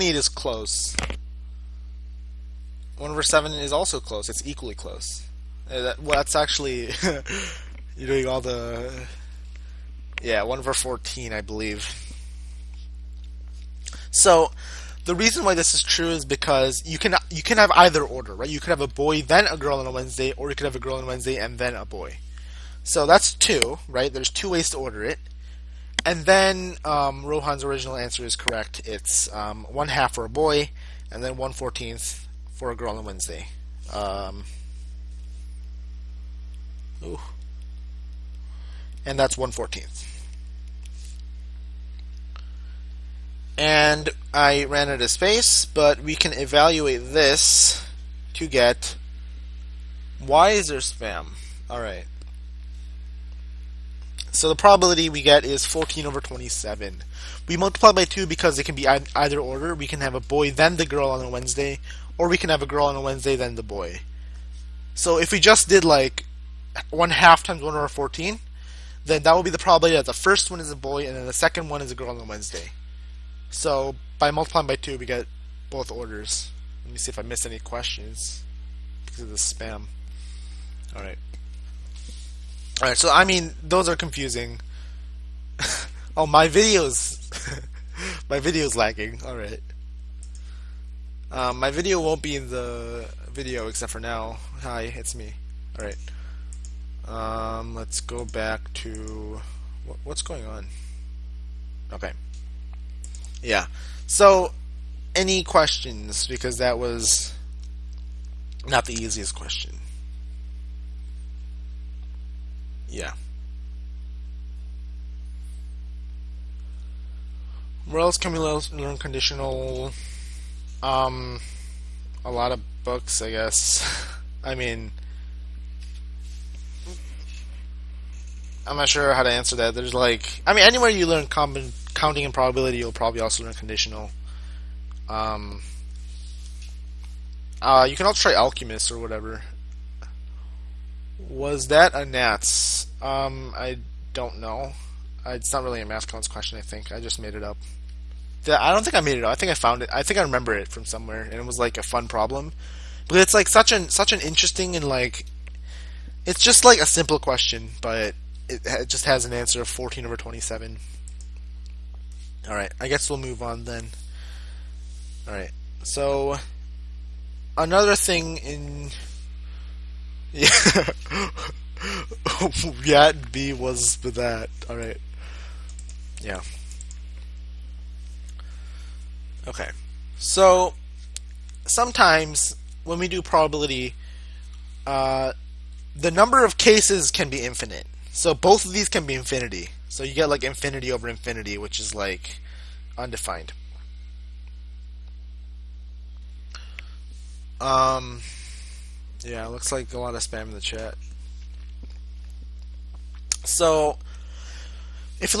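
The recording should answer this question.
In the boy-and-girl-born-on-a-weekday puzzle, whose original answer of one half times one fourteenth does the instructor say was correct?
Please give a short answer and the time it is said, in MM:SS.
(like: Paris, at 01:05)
Rohan, at 00:27.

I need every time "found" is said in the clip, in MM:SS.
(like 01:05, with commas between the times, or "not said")
02:29.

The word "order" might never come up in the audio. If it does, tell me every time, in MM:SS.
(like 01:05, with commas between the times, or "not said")
00:18, 00:24, 00:59, 01:15.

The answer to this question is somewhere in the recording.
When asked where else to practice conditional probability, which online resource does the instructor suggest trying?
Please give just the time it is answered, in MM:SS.
02:18.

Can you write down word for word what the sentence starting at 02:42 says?
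All right, I guess we'll move on then.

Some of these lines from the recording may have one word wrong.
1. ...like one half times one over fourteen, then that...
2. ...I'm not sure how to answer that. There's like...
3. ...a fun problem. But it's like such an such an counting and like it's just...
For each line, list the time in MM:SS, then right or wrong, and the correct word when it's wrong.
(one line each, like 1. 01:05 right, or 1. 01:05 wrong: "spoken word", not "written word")
1. 01:05 right
2. 02:08 right
3. 02:31 wrong: "interesting", not "counting".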